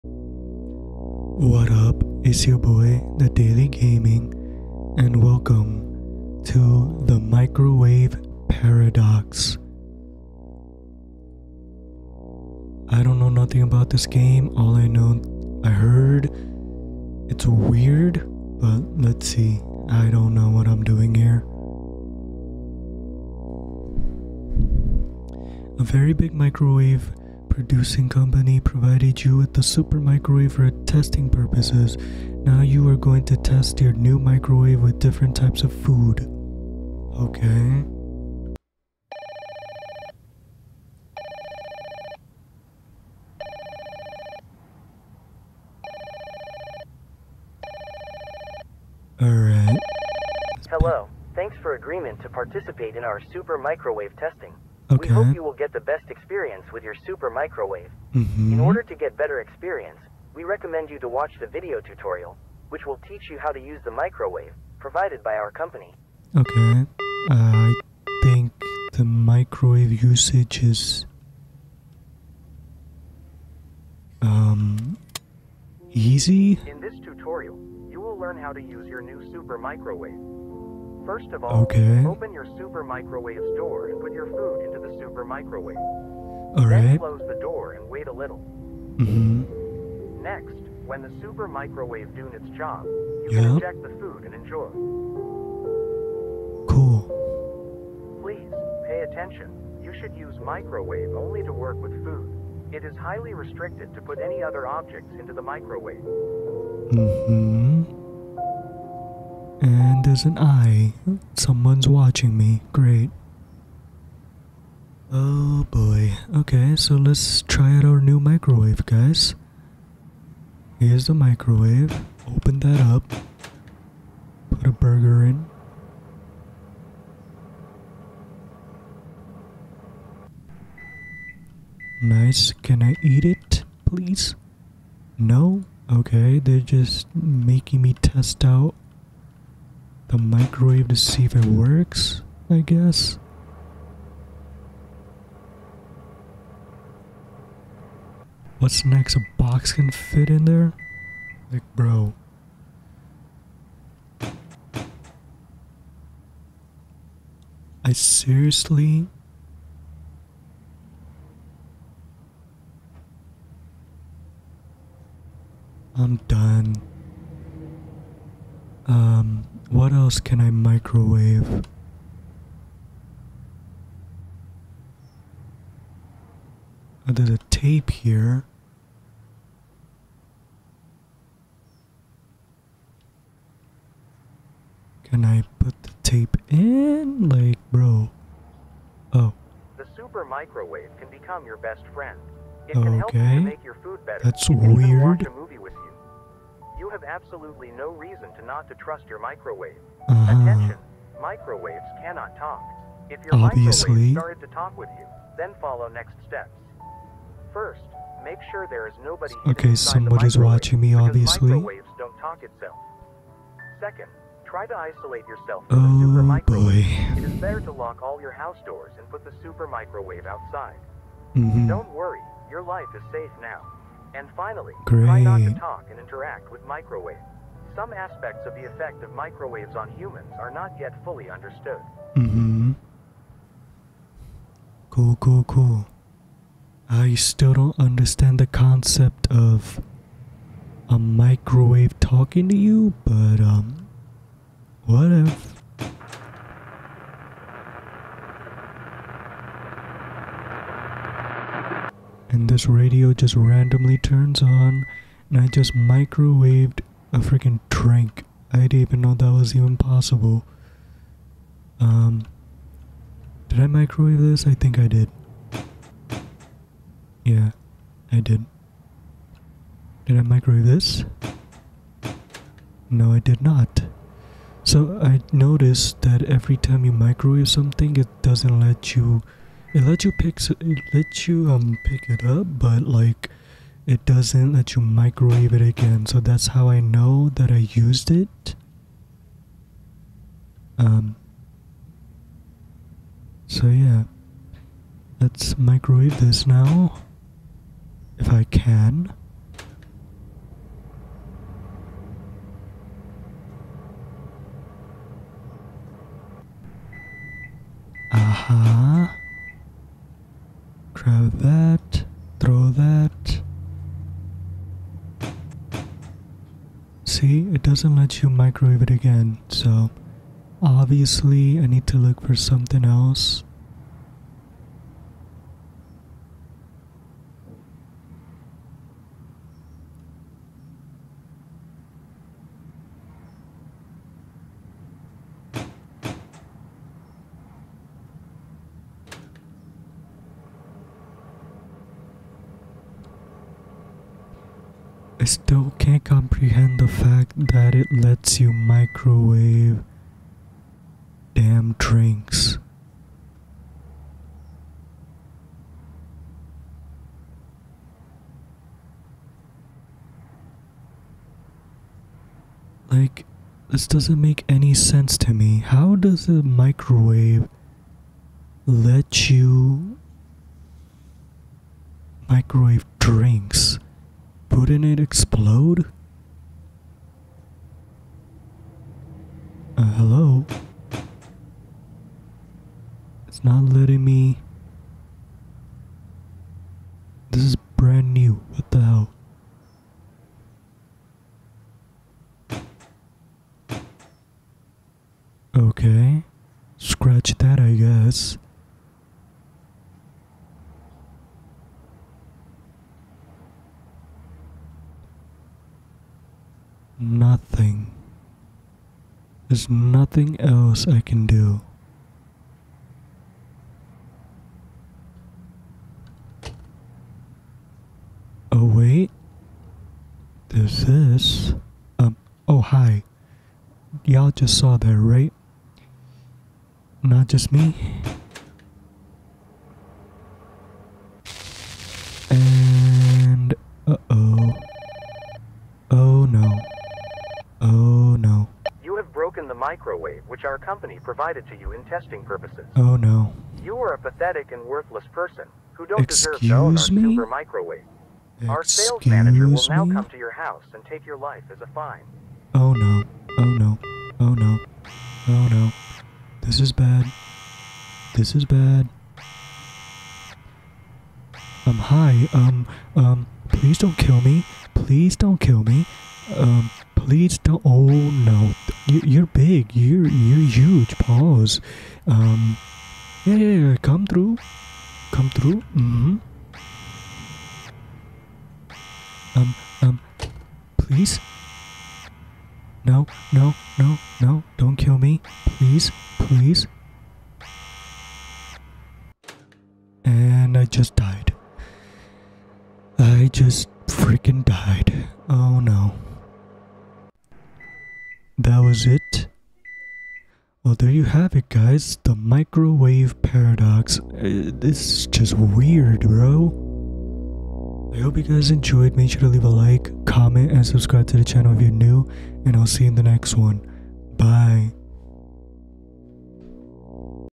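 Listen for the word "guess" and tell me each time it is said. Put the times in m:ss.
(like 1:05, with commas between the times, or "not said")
2:22, 6:37.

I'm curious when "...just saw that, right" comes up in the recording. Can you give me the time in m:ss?
7:04.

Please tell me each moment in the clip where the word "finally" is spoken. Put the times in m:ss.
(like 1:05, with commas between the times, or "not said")
3:44.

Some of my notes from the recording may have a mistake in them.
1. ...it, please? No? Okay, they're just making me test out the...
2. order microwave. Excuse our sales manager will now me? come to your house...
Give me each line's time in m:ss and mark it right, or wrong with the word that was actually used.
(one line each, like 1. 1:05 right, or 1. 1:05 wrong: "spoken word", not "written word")
1. 2:13 right
2. 7:27 wrong: "super", not "order".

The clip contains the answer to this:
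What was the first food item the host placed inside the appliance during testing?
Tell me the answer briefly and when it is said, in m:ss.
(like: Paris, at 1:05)
Burger, at 2:04.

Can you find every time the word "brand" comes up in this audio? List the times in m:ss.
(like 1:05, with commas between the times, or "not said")
6:27.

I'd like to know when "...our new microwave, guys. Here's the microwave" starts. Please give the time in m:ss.
1:57.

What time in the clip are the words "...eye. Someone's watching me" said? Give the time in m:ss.
1:50.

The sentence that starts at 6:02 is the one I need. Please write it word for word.
Like, this doesn't make any sense to me.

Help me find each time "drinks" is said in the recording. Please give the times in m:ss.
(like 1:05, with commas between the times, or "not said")
4:17, 5:51, 6:12.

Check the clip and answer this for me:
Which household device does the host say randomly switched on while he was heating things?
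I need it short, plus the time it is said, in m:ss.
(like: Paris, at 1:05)
Radio, at 4:12.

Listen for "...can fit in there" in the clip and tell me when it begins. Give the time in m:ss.
2:29.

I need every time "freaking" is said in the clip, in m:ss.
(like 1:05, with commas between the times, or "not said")
4:17, 8:13.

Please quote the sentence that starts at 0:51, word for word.
Thanks for agreement to participate in our super microwave testing.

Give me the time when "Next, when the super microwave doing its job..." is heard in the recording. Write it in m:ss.
1:30.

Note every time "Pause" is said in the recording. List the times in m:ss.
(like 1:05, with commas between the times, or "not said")
7:50.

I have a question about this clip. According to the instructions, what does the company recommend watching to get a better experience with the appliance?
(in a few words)
Video tutorial.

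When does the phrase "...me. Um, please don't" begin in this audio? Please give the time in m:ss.
7:45.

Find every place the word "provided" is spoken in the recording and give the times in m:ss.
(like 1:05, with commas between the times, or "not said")
0:28, 1:04, 7:21.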